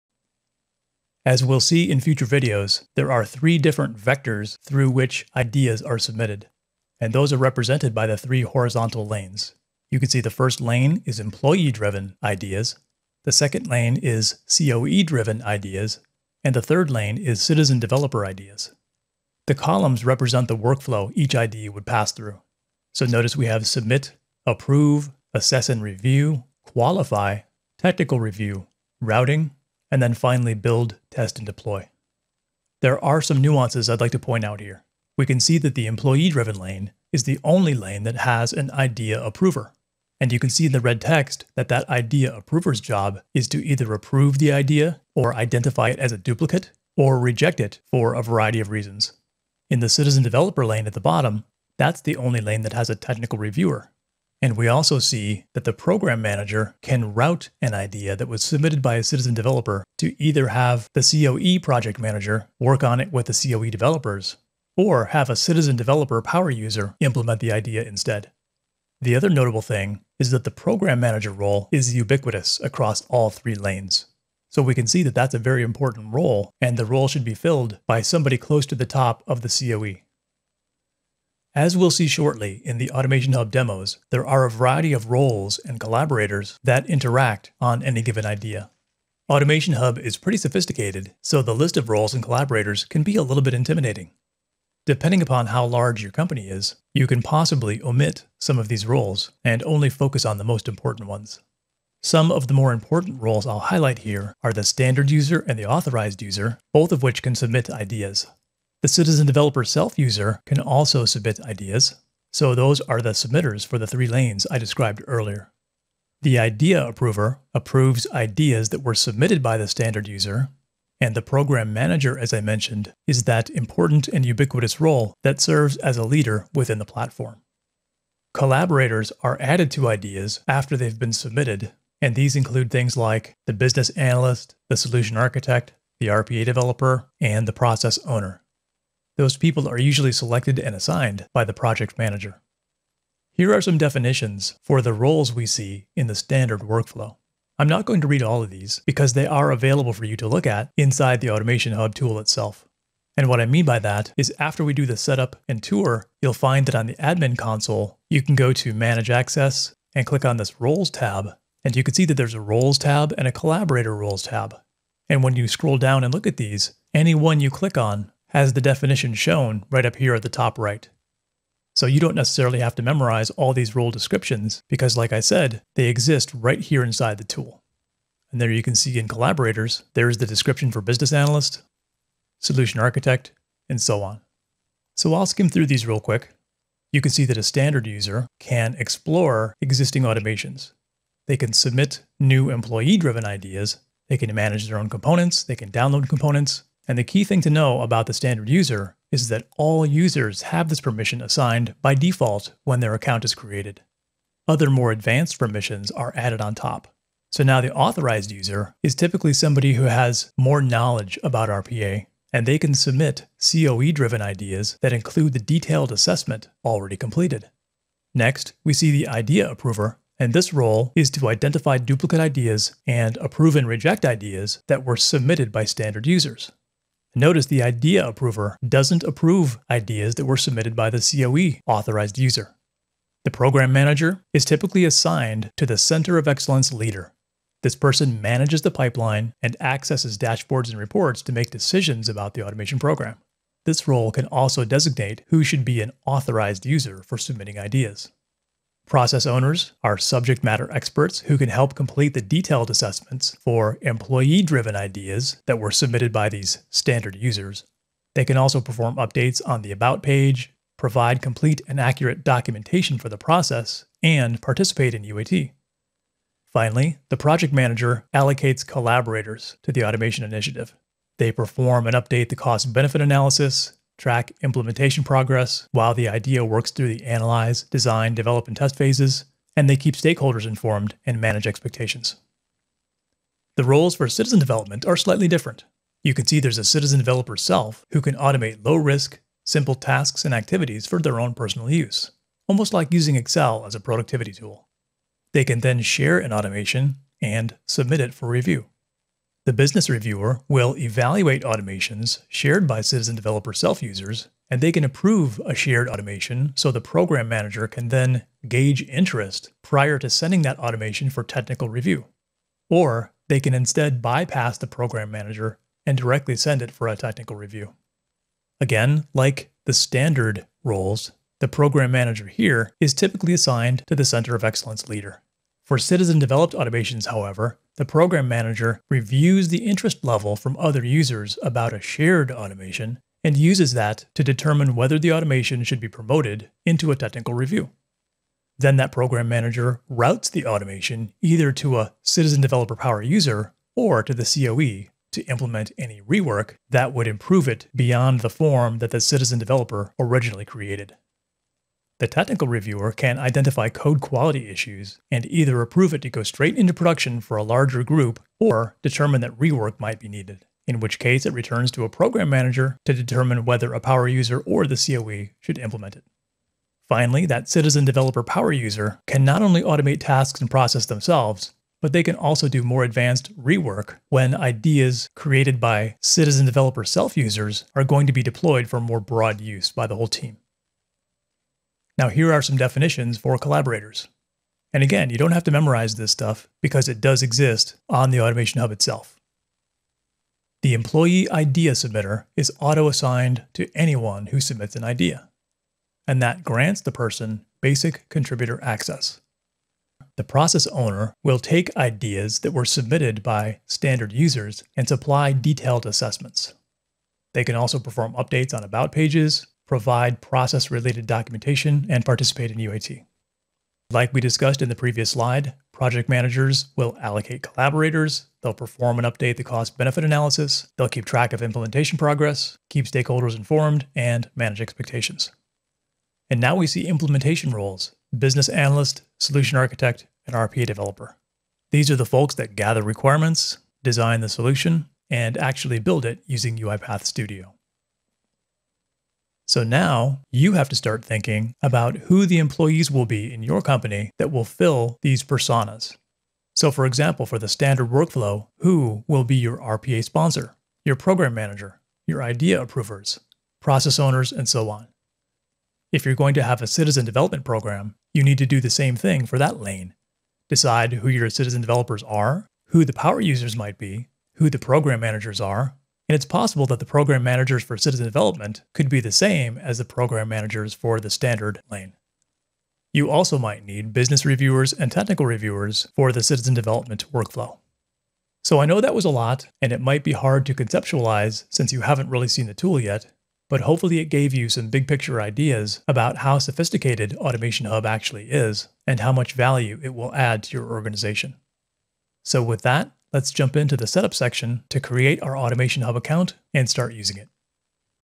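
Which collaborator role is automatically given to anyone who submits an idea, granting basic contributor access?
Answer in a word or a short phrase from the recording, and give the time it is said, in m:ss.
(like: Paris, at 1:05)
Employee idea submitter, at 6:30.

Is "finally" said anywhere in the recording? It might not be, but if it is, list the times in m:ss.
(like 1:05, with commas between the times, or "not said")
0:30, 4:26, 6:06.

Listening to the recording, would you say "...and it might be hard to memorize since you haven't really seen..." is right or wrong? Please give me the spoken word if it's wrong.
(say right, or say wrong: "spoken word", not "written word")
wrong: "conceptualize", not "memorize".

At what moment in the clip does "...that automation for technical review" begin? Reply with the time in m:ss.
5:10.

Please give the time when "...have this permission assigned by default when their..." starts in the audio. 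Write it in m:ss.
3:20.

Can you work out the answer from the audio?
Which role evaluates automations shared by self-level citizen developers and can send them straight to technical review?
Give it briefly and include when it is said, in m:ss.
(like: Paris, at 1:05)
Business reviewer, at 4:59.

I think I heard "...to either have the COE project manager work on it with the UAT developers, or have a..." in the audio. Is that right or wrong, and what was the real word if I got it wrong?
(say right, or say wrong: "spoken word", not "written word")
wrong: "COE", not "UAT".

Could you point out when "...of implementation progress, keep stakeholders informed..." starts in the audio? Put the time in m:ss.
7:01.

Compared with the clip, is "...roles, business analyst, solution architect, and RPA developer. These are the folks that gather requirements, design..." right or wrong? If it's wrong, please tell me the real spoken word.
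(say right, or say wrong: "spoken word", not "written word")
right.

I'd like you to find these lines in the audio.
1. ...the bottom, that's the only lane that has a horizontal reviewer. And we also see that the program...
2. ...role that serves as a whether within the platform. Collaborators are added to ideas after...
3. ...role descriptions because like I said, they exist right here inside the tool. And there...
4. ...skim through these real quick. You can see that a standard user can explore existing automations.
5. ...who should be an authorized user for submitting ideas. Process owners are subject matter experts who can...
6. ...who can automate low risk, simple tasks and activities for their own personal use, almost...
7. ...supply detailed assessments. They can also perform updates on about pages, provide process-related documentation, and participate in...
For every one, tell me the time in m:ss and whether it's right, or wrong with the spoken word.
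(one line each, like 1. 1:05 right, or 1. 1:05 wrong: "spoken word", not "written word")
1. 0:50 wrong: "technical", not "horizontal"
2. 2:04 wrong: "leader", not "whether"
3. 2:53 right
4. 3:05 right
5. 4:05 right
6. 4:47 right
7. 6:44 right.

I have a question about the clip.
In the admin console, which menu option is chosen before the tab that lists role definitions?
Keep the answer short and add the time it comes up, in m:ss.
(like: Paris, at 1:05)
Manage access, at 2:38.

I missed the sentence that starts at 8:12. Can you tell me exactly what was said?
So with that, Let's jump into the setup section to create our Automation Hub account and start using it.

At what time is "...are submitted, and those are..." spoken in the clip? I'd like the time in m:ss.
0:05.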